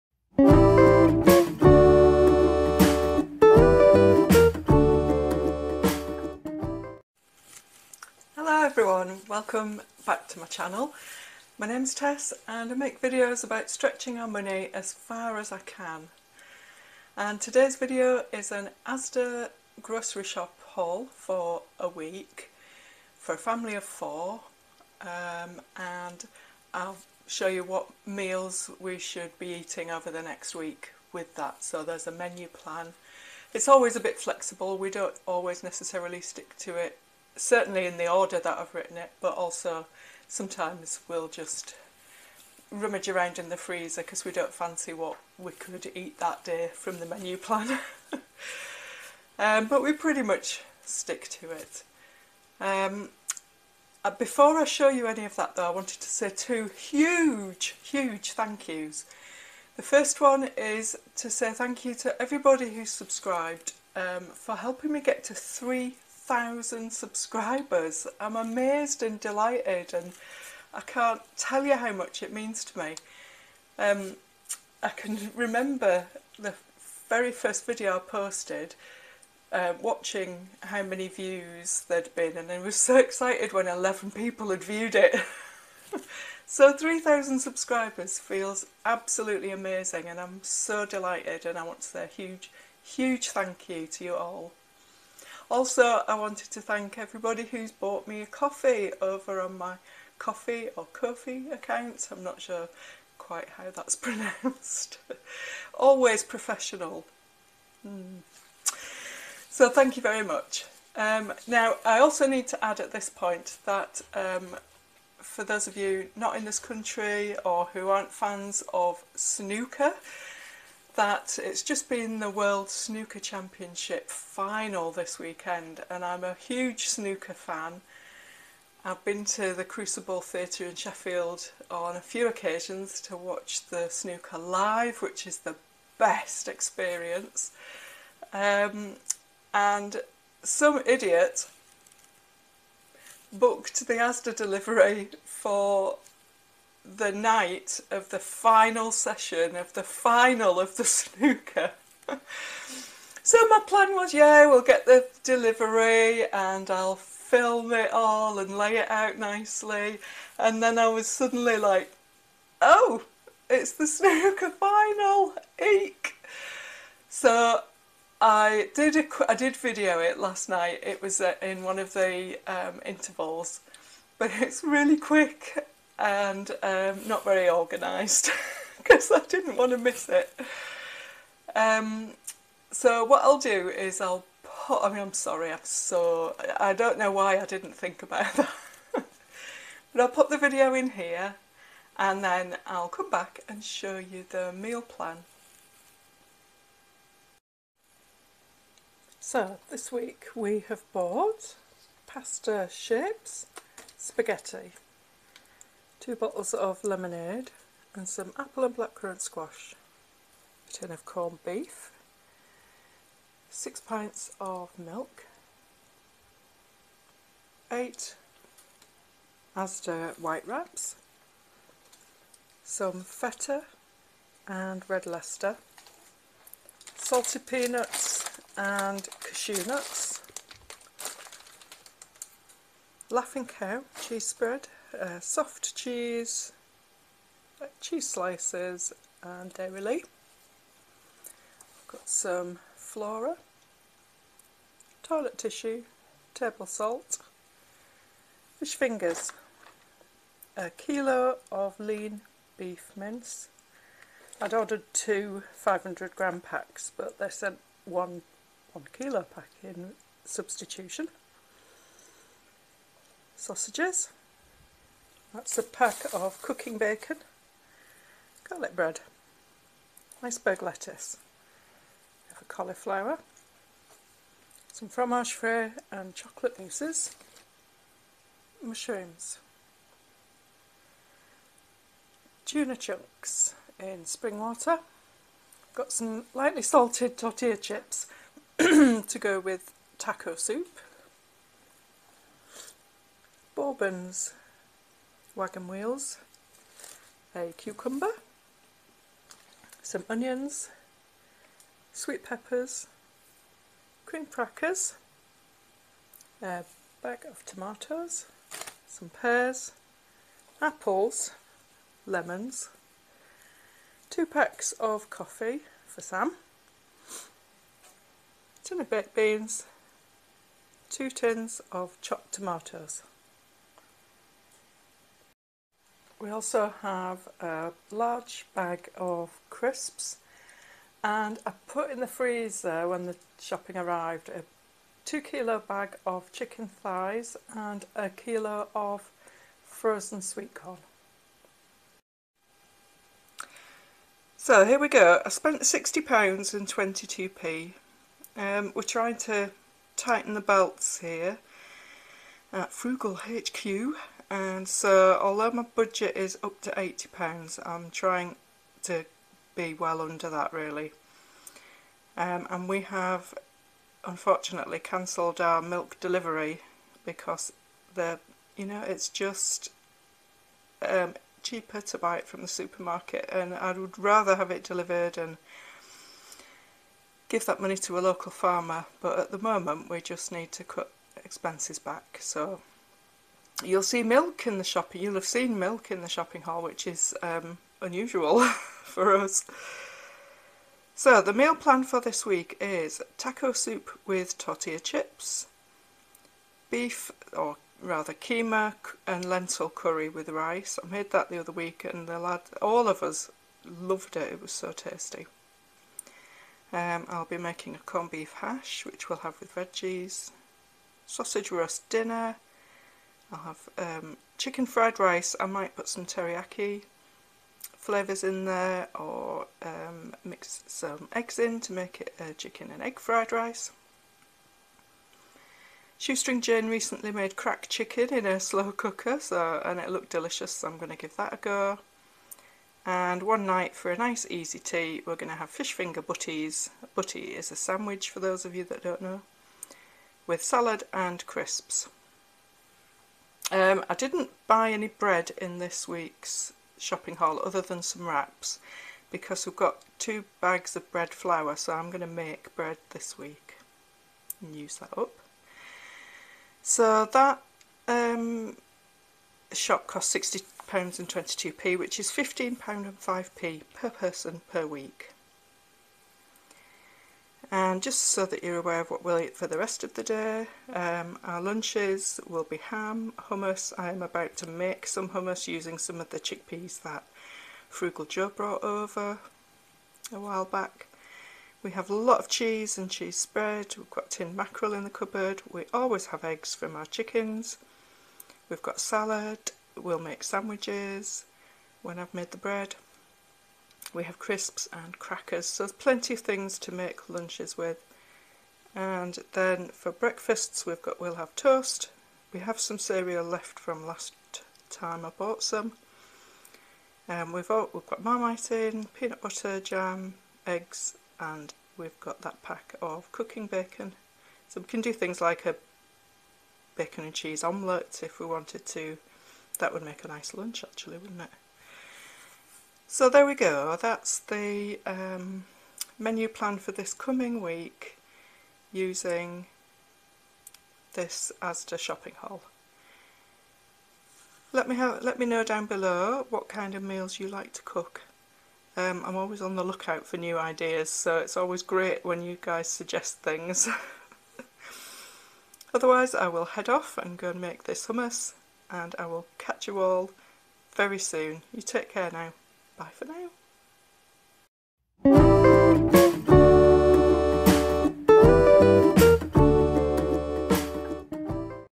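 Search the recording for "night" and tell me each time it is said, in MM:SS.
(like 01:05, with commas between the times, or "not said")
02:27, 02:50, 07:13.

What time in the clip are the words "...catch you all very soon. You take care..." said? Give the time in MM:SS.
09:09.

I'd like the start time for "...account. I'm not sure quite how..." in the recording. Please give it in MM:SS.
01:41.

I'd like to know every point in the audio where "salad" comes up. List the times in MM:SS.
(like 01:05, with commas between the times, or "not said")
07:20, 08:08.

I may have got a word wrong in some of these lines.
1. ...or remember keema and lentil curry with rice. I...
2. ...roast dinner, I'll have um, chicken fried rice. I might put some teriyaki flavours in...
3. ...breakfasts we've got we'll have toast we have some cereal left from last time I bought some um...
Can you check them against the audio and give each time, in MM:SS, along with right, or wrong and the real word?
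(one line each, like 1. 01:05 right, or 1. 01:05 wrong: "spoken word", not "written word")
1. 06:37 wrong: "rather", not "remember"
2. 06:51 right
3. 08:19 right.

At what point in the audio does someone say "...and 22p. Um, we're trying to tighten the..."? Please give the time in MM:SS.
05:46.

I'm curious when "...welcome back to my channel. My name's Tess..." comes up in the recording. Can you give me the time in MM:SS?
00:09.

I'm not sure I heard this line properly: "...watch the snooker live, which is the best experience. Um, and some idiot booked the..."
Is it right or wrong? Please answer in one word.
right.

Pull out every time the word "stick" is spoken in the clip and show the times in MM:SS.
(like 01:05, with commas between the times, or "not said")
00:36, 00:50.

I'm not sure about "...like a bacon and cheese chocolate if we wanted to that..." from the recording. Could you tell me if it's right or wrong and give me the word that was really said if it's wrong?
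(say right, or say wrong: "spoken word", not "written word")
wrong: "omelette", not "chocolate".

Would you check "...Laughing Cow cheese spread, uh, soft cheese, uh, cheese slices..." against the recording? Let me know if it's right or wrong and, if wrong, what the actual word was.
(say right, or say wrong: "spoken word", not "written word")
right.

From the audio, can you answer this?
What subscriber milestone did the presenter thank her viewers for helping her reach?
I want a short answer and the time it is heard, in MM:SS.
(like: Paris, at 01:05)
3,000, at 01:05.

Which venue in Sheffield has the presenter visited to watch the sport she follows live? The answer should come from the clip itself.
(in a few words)
Crucible Theatre.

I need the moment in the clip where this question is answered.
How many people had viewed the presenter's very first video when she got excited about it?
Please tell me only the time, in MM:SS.
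01:23.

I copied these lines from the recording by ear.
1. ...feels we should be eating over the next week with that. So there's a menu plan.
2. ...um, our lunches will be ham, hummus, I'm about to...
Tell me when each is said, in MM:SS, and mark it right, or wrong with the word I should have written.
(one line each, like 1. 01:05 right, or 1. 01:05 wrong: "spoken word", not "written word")
1. 00:28 wrong: "meals", not "feels"
2. 07:50 right.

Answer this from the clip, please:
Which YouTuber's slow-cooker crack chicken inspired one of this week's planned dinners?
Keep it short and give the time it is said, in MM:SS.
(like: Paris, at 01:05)
Shoestring Jane, at 07:05.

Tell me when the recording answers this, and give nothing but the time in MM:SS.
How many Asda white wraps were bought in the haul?
03:37.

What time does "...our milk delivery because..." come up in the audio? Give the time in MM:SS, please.
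06:05.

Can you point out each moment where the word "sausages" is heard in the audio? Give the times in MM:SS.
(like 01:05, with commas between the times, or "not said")
04:23, 06:51.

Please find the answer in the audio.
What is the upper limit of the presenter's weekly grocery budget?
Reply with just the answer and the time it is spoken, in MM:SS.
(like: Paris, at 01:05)
£80, at 05:56.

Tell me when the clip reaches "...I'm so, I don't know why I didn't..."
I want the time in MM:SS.
03:05.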